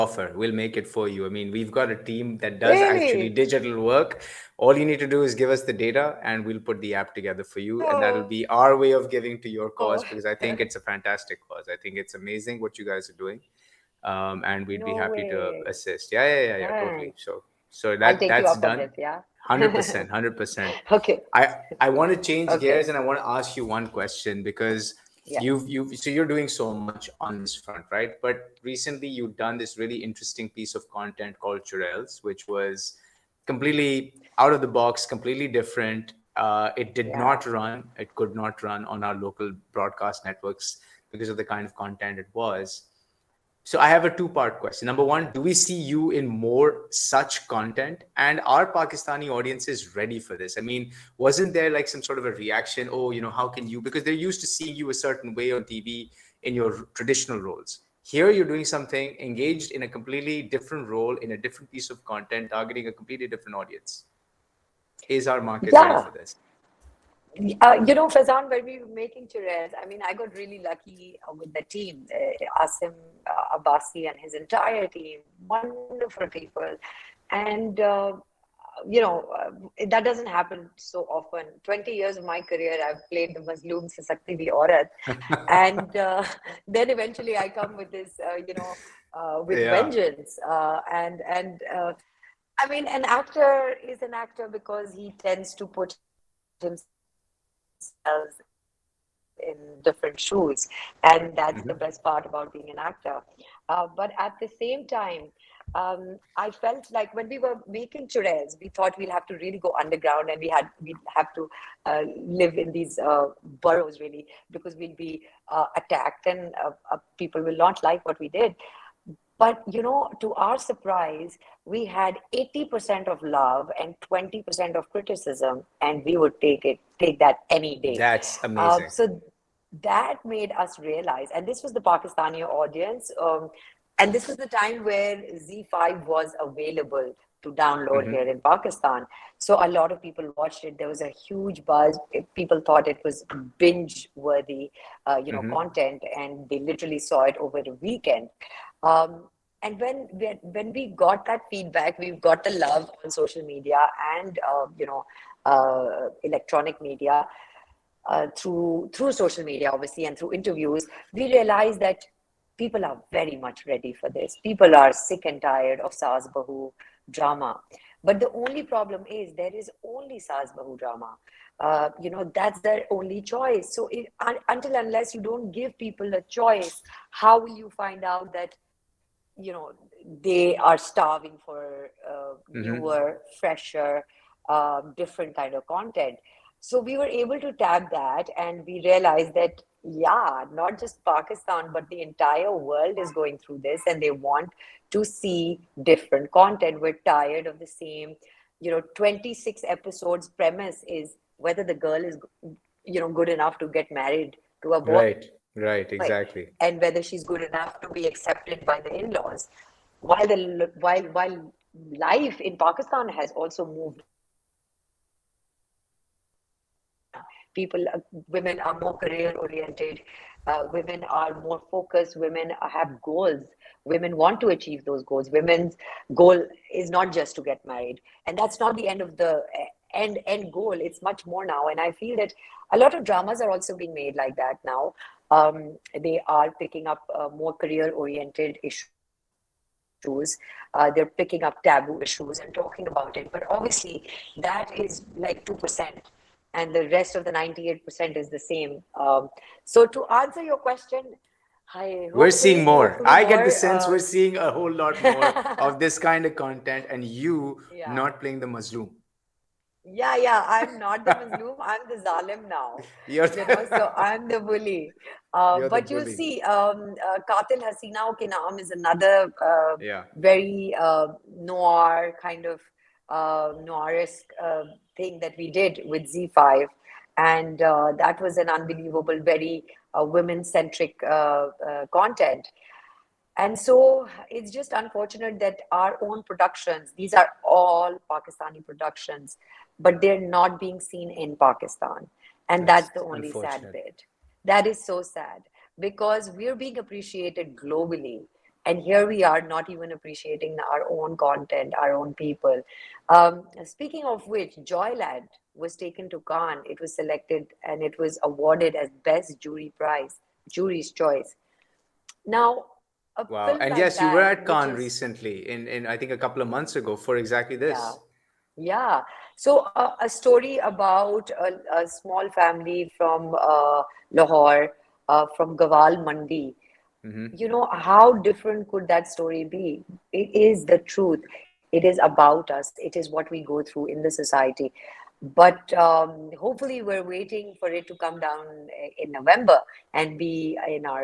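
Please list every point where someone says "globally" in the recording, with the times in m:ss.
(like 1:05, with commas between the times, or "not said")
4:57.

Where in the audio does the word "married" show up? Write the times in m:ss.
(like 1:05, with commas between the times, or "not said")
3:23, 3:47.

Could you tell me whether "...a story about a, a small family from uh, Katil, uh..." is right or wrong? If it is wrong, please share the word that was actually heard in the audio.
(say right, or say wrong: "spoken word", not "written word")
wrong: "Lahore", not "Katil".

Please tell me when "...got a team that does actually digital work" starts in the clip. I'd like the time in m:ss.
0:01.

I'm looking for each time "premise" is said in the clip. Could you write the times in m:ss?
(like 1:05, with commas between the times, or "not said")
3:20.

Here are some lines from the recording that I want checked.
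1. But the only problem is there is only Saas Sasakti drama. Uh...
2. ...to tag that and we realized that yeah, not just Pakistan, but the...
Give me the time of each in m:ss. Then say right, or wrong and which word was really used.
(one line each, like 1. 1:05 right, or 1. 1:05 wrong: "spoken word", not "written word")
1. 2:48 wrong: "Bahu", not "Sasakti"
2. 3:07 right.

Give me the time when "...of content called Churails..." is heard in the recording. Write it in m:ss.
0:30.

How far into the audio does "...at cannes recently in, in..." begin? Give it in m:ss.
5:14.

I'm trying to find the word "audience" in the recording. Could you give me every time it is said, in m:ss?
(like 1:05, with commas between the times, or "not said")
0:49, 1:03, 2:12.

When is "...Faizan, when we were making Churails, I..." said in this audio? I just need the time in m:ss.
1:08.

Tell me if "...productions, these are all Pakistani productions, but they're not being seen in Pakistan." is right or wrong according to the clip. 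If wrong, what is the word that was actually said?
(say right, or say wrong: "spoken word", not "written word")
right.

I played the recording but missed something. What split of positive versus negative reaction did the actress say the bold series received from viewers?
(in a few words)
80% love, 20% criticism.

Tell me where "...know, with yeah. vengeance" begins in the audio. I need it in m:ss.
1:28.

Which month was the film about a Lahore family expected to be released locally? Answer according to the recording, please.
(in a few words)
November.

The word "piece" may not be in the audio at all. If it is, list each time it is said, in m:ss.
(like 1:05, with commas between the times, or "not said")
0:30, 1:01.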